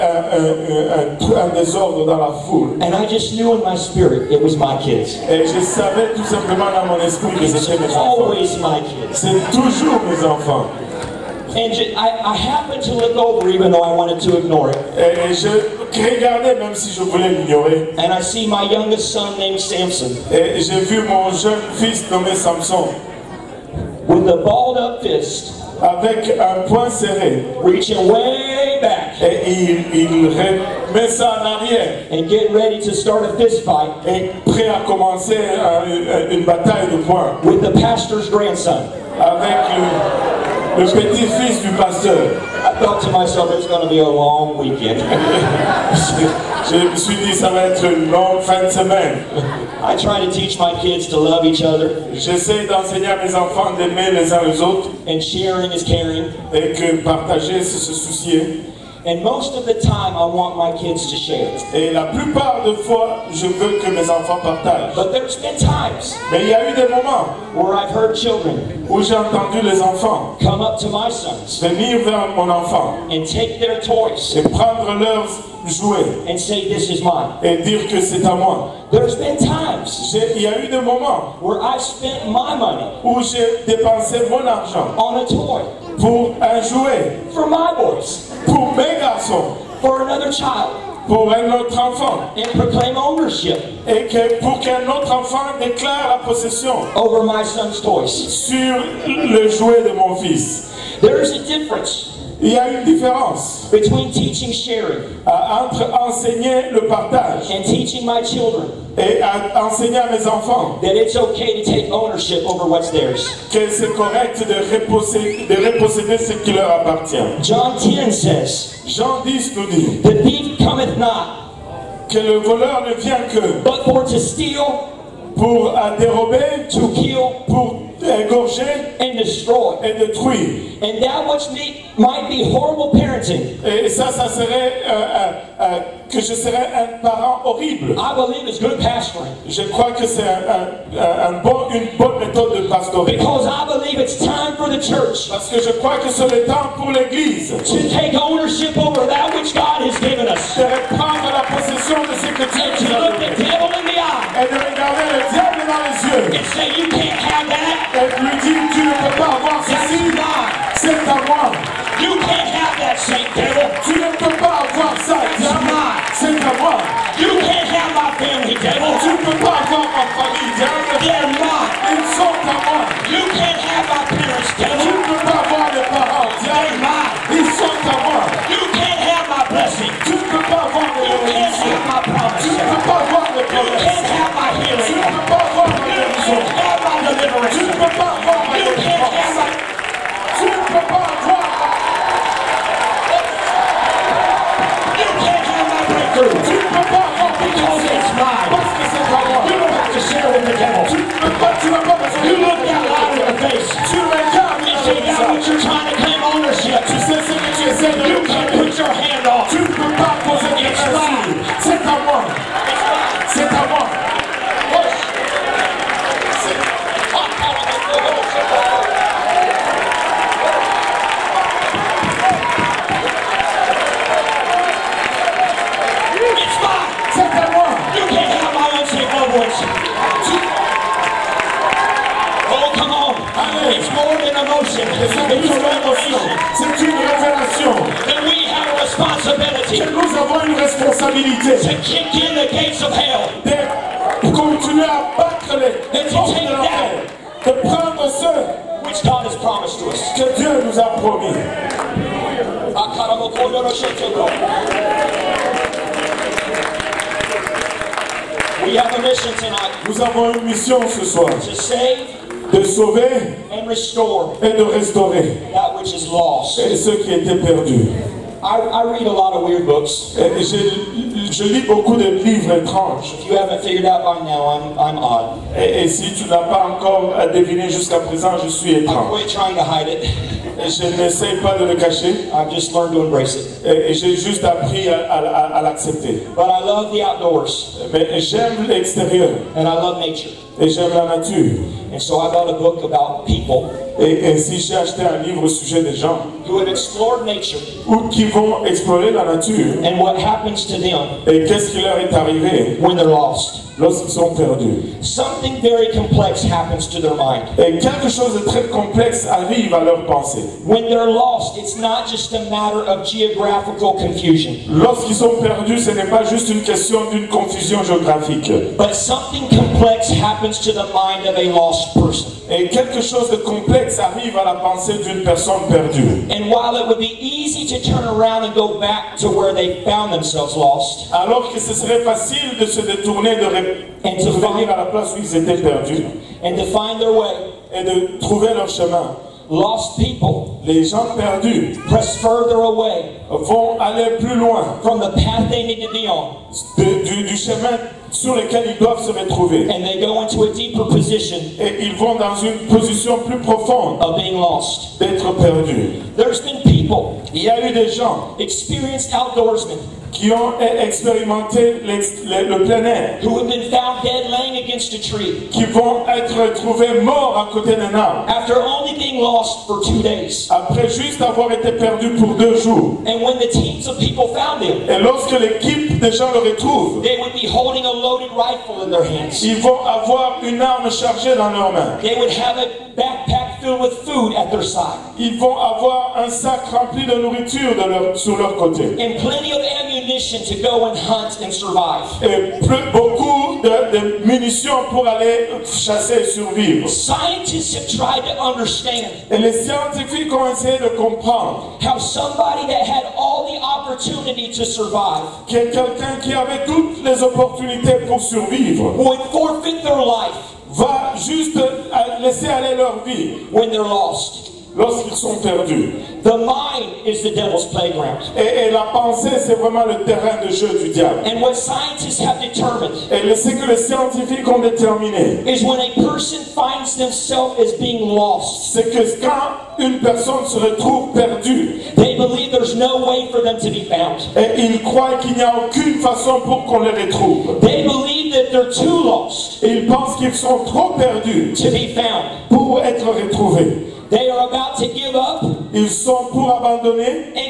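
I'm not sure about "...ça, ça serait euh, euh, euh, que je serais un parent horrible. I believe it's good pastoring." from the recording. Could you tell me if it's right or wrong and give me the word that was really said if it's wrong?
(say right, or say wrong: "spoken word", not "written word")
right.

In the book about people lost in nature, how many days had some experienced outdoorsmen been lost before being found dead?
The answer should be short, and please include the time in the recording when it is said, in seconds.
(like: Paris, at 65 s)
2, at 369 s.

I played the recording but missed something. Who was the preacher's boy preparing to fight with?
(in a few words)
The pastor's grandson.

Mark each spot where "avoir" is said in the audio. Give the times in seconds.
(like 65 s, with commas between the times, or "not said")
159 s, 164 s, 371 s, 379 s, 385 s.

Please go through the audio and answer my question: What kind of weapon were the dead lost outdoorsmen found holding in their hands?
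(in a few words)
Loaded rifle.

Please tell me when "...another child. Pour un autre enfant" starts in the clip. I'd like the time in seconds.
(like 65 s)
90 s.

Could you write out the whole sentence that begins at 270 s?
Et je, je lis beaucoup de livres étranges.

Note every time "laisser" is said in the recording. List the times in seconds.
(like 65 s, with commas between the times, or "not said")
412 s.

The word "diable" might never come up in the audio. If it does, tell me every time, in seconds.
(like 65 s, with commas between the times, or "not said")
155 s, 165 s, 420 s.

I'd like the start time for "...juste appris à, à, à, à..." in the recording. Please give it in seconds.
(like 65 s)
284 s.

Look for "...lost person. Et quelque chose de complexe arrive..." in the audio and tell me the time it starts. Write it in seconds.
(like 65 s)
321 s.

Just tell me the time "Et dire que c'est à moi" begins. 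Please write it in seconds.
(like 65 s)
77 s.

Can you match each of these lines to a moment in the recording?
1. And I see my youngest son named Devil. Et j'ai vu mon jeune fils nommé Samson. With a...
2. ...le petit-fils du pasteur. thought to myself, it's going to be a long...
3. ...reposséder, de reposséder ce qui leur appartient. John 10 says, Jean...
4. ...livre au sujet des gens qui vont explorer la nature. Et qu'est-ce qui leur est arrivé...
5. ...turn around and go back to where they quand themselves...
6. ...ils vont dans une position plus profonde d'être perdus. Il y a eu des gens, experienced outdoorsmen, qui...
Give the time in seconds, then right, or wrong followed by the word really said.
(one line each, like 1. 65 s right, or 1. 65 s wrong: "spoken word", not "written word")
1. 17 s wrong: "Samson", not "Devil"
2. 40 s right
3. 114 s right
4. 295 s right
5. 327 s wrong: "found", not "quand"
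6. 351 s right.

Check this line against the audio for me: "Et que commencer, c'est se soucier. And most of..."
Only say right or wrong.
wrong.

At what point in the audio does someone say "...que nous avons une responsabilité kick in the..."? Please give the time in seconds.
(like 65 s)
239 s.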